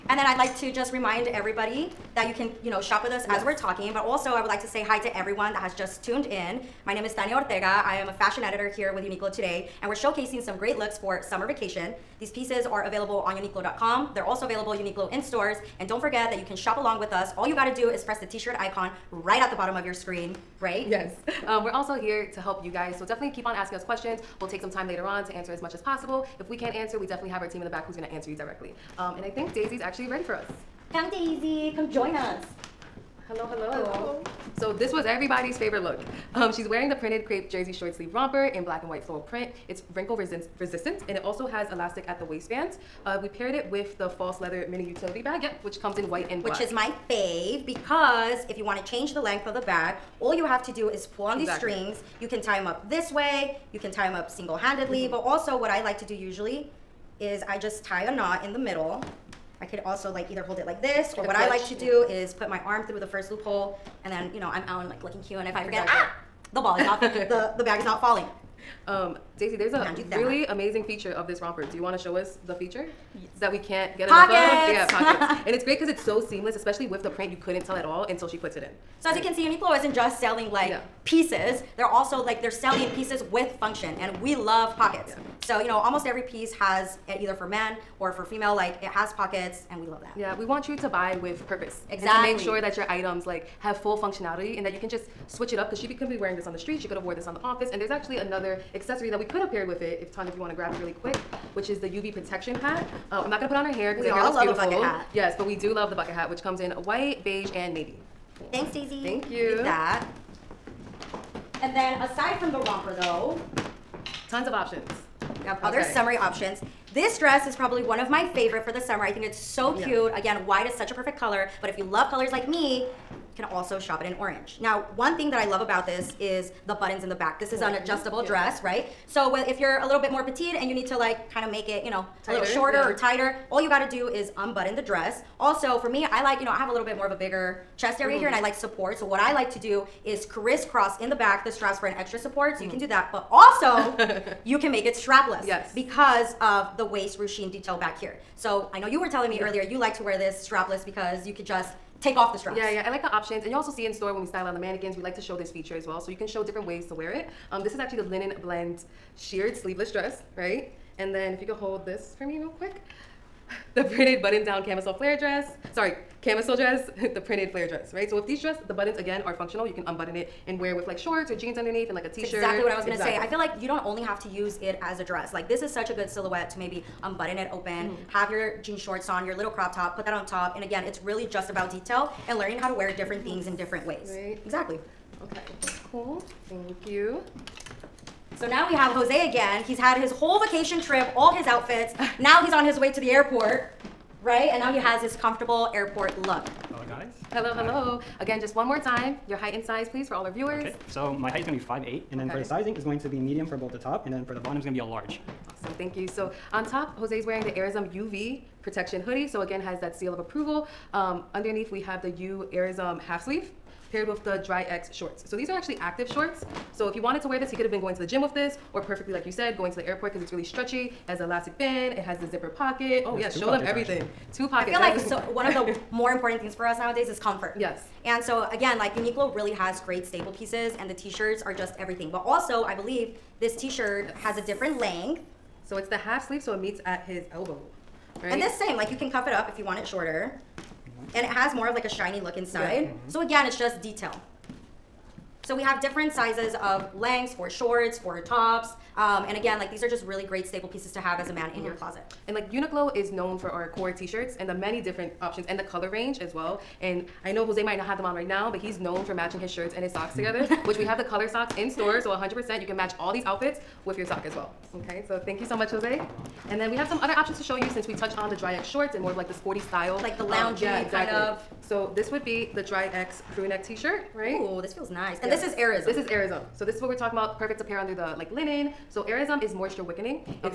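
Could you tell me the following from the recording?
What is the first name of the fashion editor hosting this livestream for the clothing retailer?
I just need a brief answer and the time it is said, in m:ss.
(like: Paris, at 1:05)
Tania, at 0:07.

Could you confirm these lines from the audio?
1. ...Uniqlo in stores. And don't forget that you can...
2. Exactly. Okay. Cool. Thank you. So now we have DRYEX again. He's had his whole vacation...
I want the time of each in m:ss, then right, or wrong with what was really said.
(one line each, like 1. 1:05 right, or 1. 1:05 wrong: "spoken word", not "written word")
1. 0:14 right
2. 3:04 wrong: "Jose", not "DRYEX".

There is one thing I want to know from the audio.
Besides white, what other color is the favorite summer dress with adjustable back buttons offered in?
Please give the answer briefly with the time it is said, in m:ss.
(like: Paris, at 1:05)
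Orange, at 2:04.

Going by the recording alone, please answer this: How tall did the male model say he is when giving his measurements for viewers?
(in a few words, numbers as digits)
5'8".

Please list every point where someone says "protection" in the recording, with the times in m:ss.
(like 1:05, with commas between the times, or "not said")
1:42, 3:28.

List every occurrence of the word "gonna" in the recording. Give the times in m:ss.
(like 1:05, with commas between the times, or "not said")
0:27, 1:43, 2:52.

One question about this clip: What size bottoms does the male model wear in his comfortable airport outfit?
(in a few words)
Large.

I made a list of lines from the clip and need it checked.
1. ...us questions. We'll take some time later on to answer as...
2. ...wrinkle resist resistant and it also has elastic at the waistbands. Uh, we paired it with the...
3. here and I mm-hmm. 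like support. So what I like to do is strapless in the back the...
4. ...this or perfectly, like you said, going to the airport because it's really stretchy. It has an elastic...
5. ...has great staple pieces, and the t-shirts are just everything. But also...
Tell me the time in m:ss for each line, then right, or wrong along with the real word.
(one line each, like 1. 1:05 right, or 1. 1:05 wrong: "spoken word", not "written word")
1. 0:23 right
2. 0:39 right
3. 2:18 wrong: "crisscross", not "strapless"
4. 3:38 right
5. 3:49 right.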